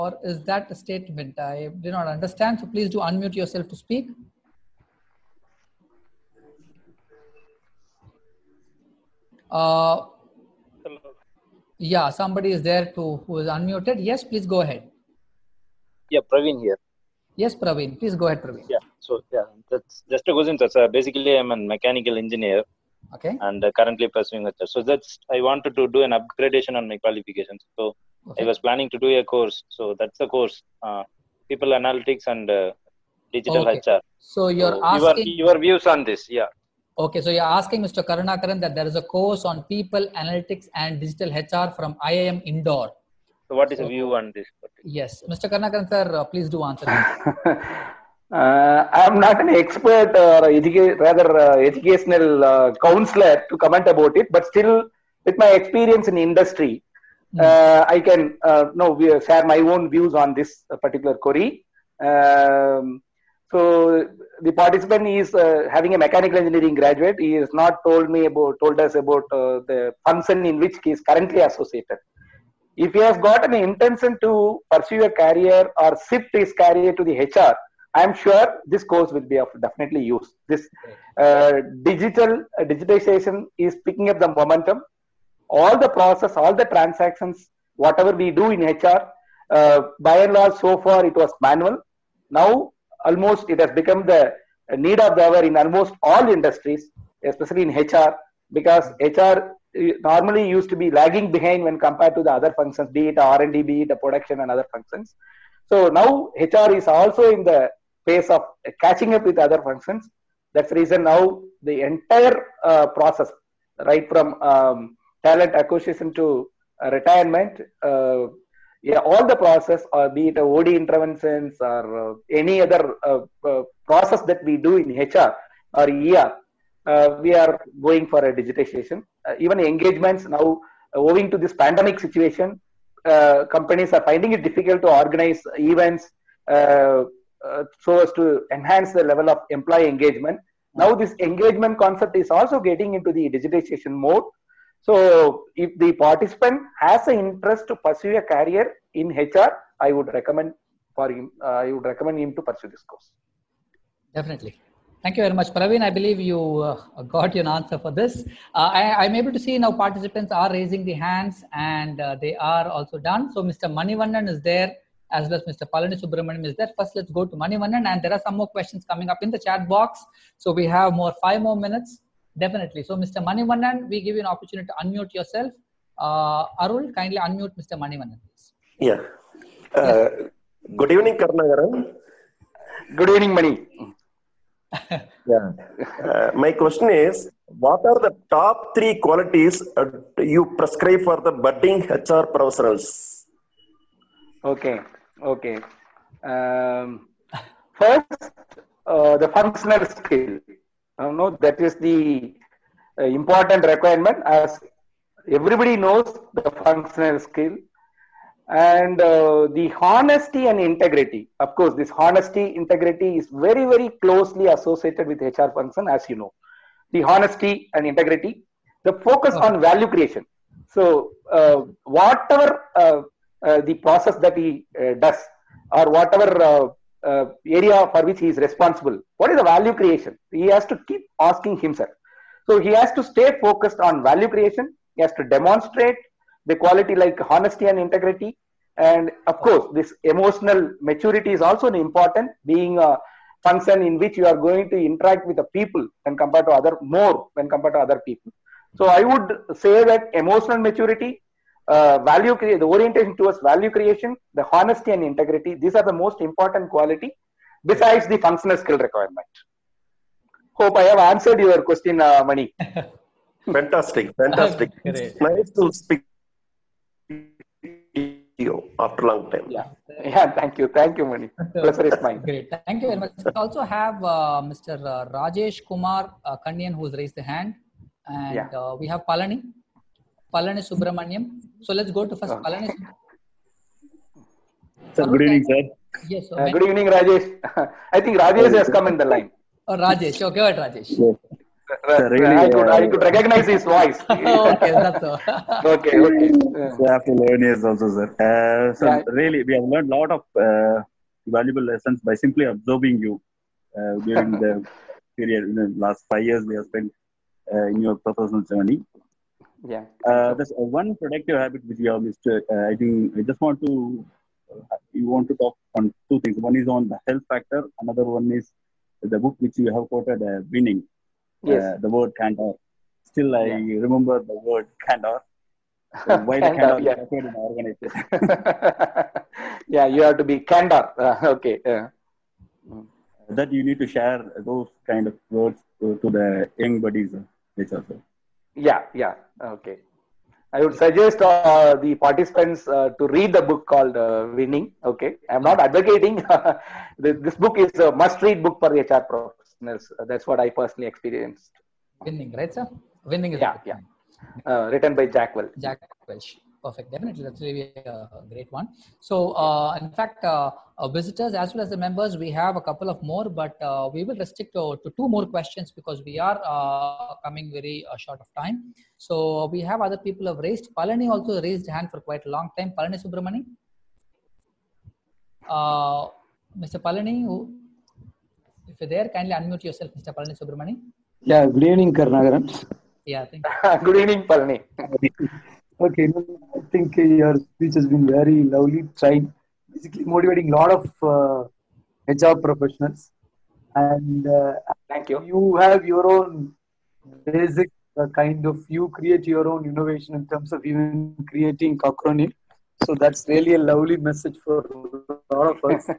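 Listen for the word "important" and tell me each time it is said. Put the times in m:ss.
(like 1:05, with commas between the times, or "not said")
3:23, 4:01, 4:16.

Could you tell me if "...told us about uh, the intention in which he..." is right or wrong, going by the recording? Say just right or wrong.
wrong.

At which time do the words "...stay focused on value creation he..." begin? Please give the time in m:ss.
3:53.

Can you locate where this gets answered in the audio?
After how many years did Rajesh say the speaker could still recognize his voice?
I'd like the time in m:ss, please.
4:57.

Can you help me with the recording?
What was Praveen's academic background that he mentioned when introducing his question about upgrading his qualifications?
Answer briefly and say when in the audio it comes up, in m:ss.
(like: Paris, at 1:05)
Mechanical engineer, at 0:21.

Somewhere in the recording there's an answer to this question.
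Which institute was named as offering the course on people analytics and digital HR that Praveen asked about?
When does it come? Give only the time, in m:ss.
0:42.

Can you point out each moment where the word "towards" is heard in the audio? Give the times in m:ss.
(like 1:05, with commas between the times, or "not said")
4:13.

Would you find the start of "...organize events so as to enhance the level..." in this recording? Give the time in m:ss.
2:14.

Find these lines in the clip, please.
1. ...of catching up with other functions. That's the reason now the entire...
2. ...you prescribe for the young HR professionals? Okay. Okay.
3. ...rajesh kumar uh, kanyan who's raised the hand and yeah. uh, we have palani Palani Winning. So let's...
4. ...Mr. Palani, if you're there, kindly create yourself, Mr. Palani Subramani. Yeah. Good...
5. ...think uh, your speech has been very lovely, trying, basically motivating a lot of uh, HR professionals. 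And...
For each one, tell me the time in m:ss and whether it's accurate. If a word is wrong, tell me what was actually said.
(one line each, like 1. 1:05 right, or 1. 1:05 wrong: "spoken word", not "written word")
1. 1:48 right
2. 3:10 wrong: "budding", not "young"
3. 4:35 wrong: "Subramaniam", not "Winning"
4. 6:16 wrong: "unmute", not "create"
5. 6:26 right.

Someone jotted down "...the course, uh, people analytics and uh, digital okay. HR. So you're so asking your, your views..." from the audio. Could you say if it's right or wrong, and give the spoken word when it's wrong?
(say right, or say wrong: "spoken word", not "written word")
right.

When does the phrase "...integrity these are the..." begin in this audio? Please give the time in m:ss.
4:15.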